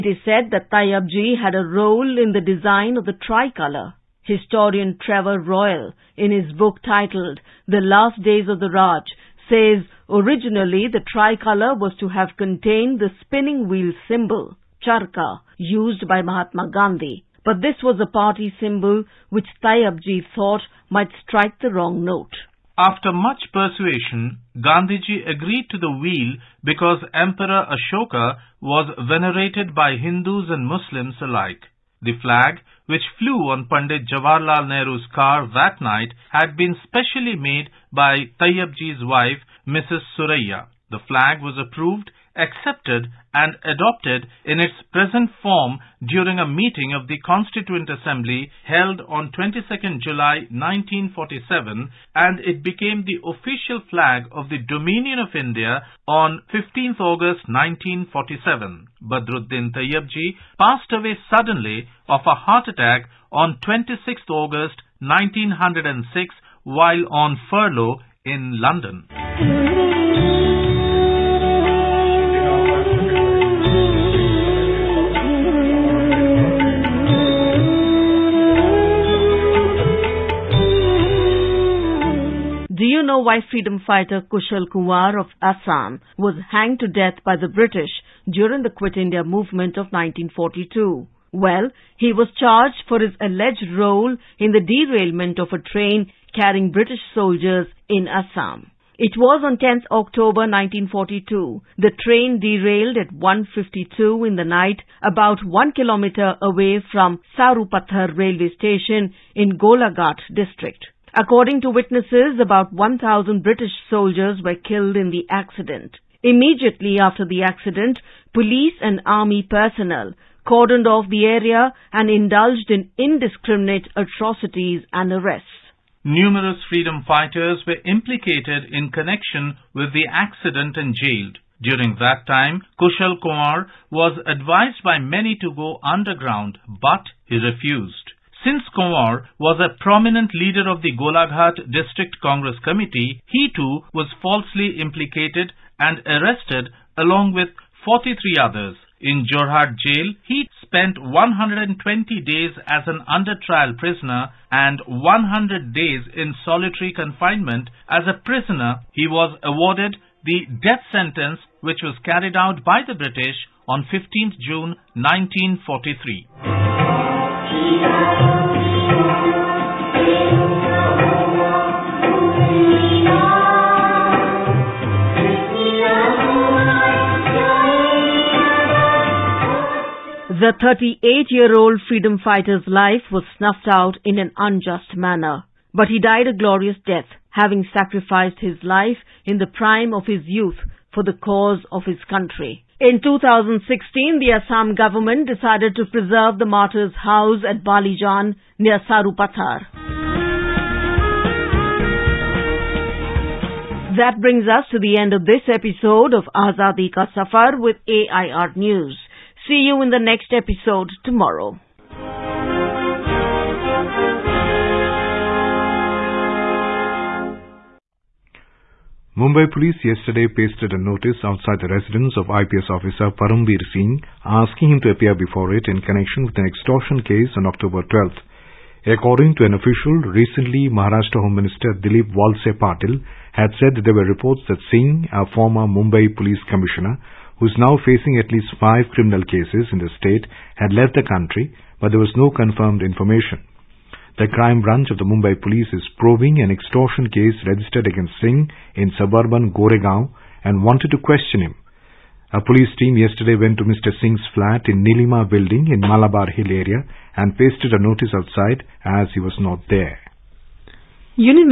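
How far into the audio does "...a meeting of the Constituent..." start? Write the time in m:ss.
0:46.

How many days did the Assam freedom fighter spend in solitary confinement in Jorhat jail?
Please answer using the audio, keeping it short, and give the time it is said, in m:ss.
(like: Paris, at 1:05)
100, at 2:34.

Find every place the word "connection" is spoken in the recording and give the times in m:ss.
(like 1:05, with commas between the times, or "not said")
2:08, 3:45.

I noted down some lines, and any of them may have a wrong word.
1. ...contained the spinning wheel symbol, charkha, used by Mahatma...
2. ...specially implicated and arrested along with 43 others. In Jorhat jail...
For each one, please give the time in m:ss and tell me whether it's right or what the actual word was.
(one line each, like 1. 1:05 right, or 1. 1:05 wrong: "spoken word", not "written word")
1. 0:12 right
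2. 2:24 wrong: "falsely", not "specially".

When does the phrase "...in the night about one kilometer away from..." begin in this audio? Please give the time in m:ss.
1:44.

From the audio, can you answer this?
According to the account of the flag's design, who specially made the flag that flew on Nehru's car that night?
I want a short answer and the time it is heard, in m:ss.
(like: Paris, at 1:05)
Mrs. Suraya, at 0:39.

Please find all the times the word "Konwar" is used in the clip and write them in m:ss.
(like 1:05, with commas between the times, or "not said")
1:24, 2:13, 2:18.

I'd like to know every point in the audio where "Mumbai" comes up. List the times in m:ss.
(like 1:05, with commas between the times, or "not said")
3:39, 3:55, 4:05.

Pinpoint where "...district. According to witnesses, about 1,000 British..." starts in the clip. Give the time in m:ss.
1:50.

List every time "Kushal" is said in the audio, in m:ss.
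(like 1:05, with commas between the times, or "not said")
1:24, 2:12.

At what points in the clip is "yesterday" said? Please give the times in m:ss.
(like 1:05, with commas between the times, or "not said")
3:39, 4:12.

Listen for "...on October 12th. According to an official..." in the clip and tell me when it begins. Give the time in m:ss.
3:47.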